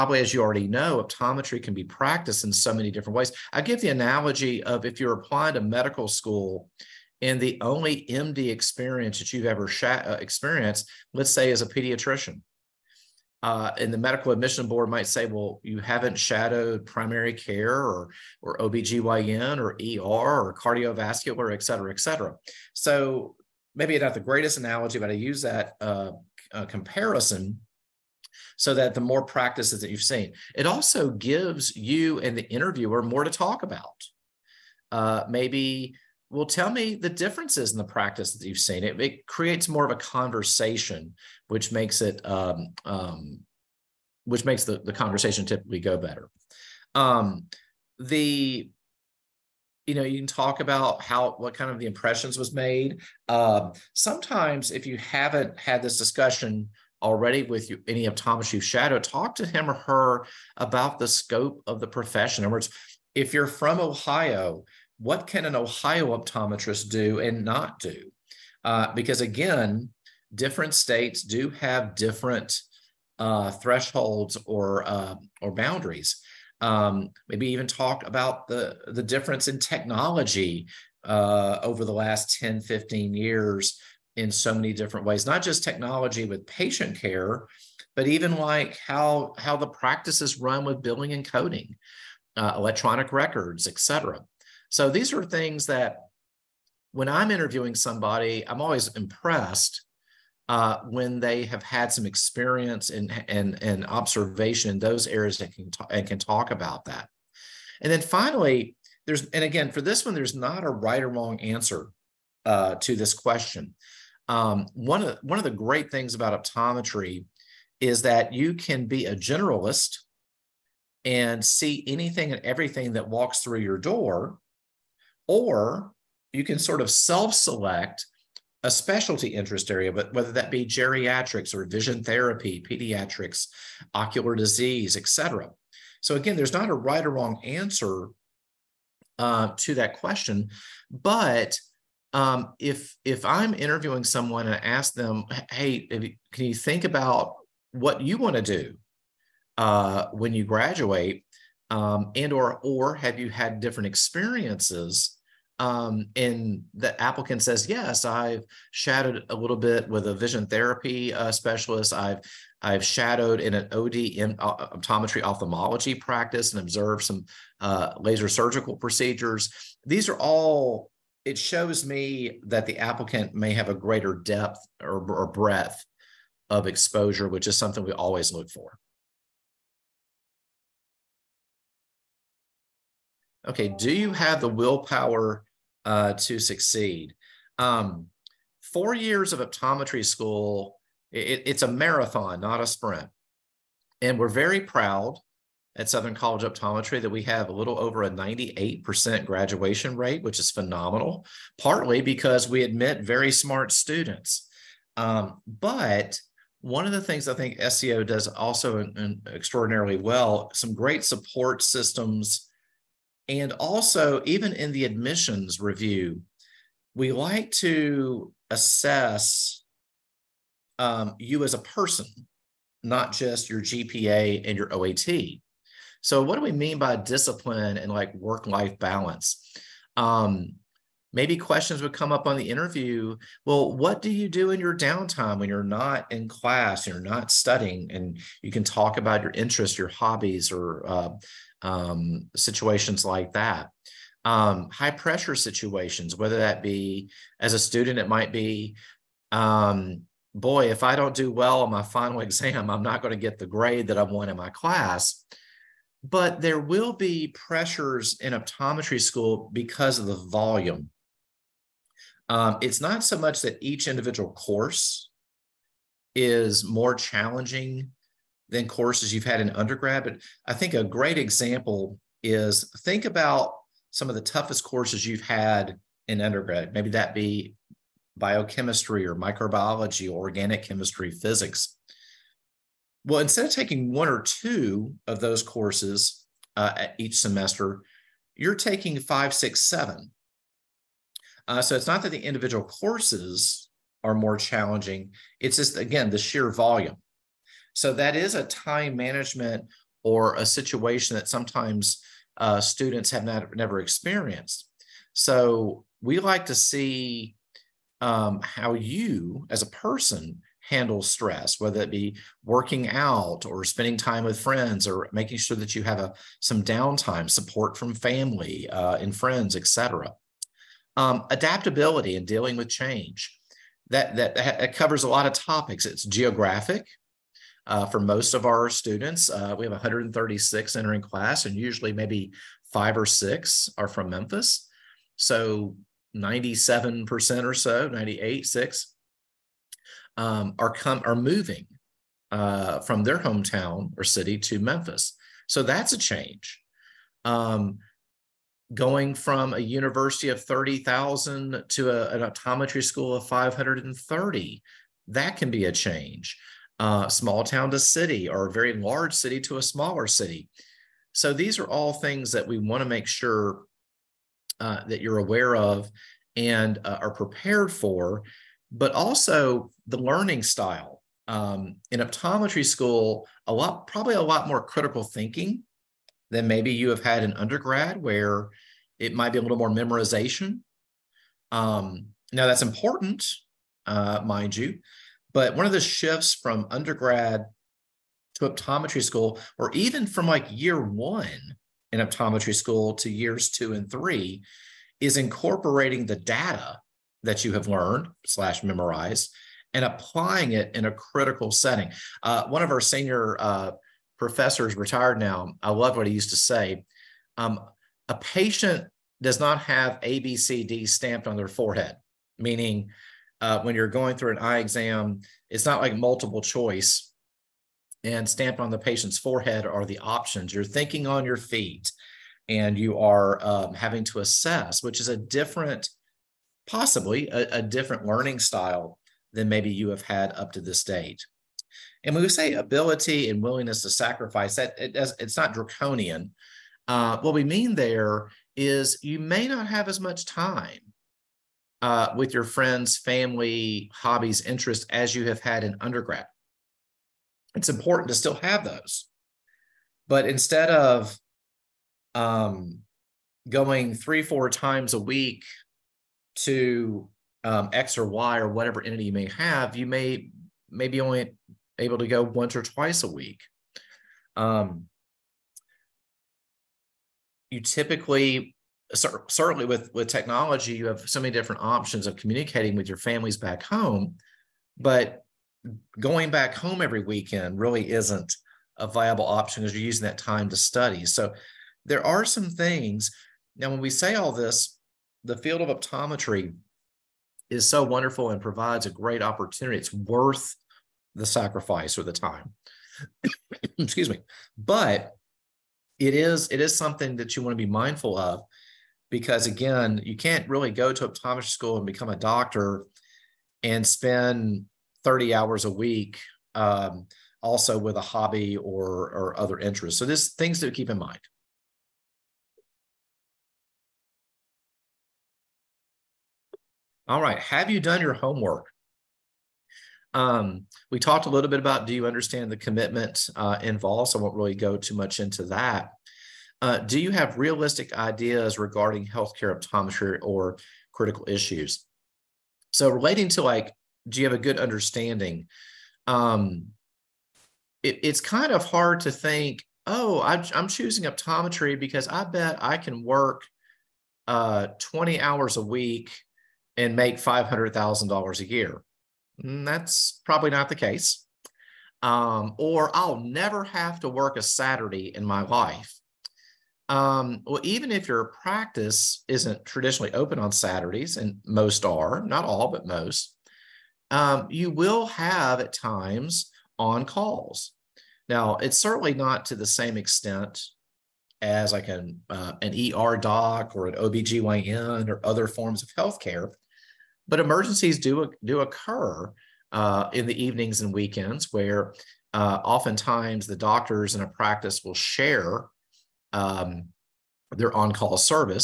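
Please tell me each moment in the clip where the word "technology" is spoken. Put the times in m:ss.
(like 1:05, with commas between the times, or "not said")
1:19, 1:25, 7:50.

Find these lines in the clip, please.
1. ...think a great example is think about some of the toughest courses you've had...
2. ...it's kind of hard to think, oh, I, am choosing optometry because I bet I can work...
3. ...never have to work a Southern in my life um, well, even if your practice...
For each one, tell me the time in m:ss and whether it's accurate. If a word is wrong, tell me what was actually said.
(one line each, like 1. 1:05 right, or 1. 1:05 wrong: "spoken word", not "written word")
1. 4:30 right
2. 8:58 right
3. 9:13 wrong: "Saturday", not "Southern".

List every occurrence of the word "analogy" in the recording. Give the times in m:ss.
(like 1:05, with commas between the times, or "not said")
0:03, 0:24.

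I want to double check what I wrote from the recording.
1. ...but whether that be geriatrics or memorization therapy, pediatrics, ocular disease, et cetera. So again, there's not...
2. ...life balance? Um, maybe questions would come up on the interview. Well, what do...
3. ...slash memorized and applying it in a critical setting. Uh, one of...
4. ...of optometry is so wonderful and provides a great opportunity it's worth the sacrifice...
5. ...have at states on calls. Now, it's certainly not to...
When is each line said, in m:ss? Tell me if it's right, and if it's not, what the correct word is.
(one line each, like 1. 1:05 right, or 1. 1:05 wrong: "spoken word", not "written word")
1. 2:09 wrong: "vision", not "memorization"
2. 3:48 right
3. 6:38 right
4. 8:05 right
5. 9:25 wrong: "times", not "states".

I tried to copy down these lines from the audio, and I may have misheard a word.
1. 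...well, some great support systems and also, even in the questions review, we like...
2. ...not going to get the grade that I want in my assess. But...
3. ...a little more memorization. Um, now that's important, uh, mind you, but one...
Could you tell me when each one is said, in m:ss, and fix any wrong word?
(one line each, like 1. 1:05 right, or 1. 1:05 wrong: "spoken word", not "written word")
1. 3:29 wrong: "admissions", not "questions"
2. 4:12 wrong: "class", not "assess"
3. 6:19 right.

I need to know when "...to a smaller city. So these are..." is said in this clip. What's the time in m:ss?
5:59.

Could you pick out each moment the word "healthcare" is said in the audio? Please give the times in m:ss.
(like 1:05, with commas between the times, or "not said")
8:49, 9:35.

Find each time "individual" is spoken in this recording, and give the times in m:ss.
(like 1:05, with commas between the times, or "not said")
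4:23, 4:52.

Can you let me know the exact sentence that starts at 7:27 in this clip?
It's important to still have those.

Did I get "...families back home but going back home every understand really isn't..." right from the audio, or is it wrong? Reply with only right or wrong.
wrong.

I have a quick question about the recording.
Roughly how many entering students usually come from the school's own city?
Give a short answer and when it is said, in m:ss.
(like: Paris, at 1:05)
5 or 6, at 5:32.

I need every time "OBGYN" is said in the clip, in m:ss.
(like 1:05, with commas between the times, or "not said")
0:18, 9:33.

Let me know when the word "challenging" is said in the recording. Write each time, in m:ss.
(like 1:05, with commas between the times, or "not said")
4:26, 4:54.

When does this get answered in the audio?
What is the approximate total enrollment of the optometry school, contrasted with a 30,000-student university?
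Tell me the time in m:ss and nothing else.
5:53.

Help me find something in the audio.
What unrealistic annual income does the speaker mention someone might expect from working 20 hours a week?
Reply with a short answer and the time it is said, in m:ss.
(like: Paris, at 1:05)
$500,000, at 9:07.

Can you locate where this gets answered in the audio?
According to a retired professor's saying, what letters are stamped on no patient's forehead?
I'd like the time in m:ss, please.
6:50.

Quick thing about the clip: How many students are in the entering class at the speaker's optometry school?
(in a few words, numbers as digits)
136.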